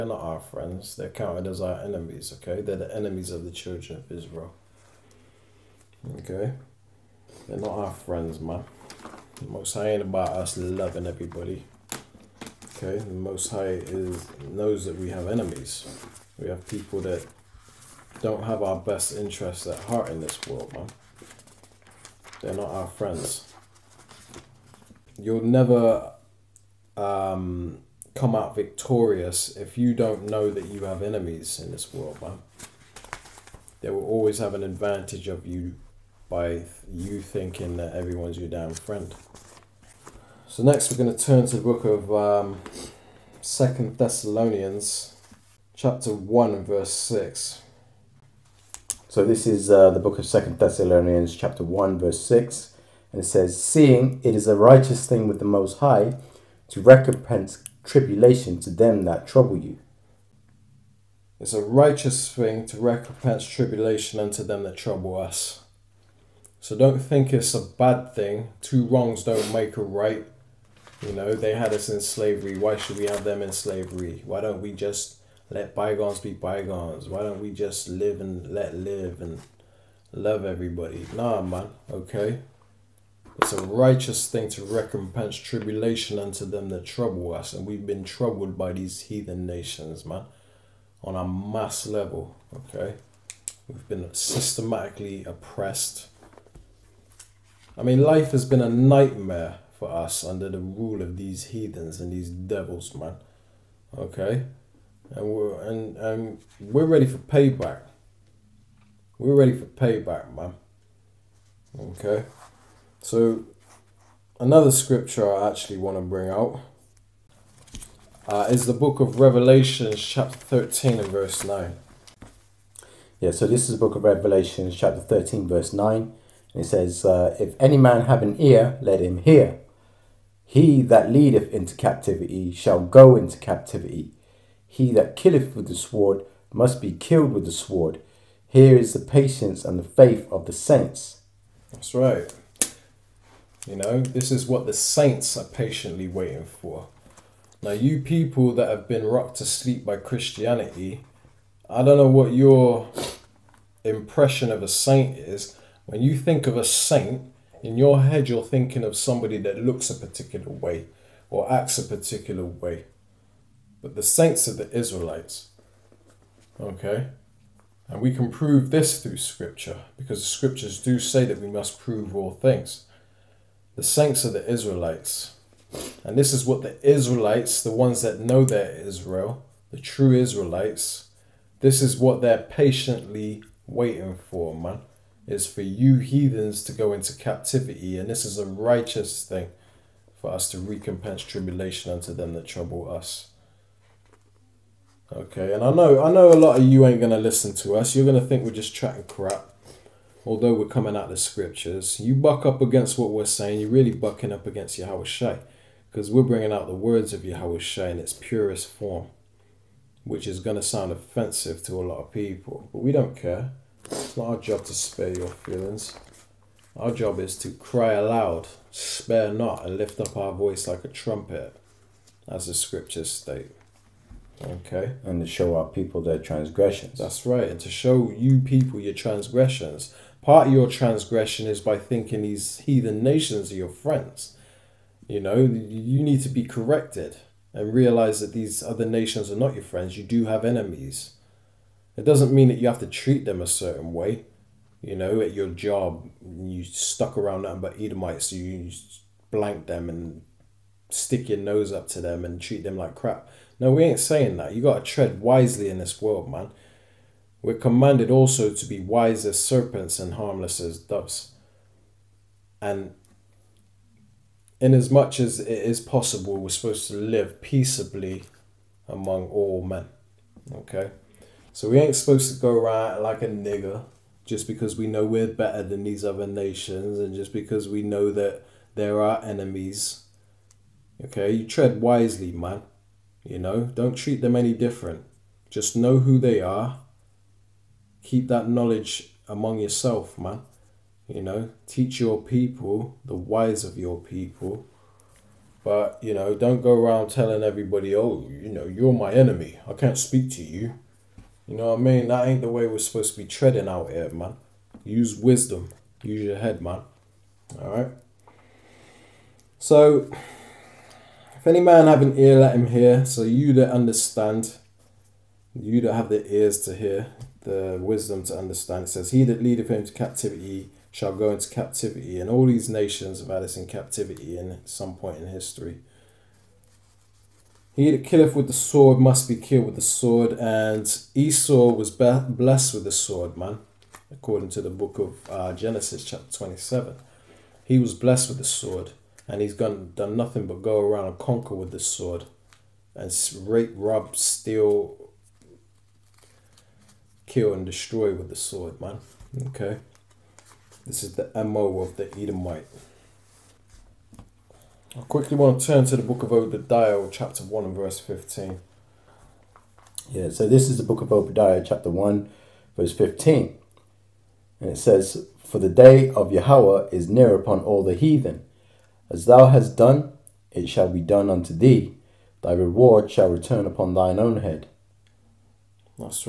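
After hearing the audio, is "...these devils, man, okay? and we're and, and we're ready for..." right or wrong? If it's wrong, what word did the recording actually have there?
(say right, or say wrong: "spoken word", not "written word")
right.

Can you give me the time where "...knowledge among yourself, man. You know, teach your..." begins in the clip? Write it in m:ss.
4:48.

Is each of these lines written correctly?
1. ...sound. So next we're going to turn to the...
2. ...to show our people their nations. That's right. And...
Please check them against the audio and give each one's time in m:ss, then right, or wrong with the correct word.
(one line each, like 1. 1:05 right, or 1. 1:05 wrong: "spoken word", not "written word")
1. 0:38 wrong: "friend", not "sound"
2. 3:45 wrong: "transgressions", not "nations".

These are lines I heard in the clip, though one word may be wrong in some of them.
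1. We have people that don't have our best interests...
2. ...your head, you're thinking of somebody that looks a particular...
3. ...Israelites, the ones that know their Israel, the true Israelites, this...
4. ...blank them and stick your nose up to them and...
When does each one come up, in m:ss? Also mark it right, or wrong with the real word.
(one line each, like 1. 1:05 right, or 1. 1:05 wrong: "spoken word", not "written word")
1. 0:16 right
2. 2:37 right
3. 2:56 right
4. 4:09 right.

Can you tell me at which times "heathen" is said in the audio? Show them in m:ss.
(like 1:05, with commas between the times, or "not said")
1:29, 1:41, 3:05, 3:52, 6:07.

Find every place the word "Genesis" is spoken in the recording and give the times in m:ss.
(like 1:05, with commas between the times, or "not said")
5:35.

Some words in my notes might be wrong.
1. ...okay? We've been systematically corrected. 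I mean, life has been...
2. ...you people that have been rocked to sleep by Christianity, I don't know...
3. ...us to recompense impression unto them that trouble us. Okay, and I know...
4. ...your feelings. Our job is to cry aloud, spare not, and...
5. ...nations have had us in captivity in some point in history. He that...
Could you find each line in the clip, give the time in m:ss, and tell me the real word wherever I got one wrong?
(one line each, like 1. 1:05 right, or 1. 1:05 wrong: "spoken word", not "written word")
1. 1:32 wrong: "oppressed", not "corrected"
2. 2:27 right
3. 3:10 wrong: "tribulation", not "impression"
4. 3:35 right
5. 5:22 right.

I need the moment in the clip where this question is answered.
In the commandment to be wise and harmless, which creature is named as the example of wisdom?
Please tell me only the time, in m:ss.
4:19.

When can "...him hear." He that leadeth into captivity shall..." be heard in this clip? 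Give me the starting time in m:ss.
2:09.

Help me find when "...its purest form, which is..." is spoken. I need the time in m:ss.
3:27.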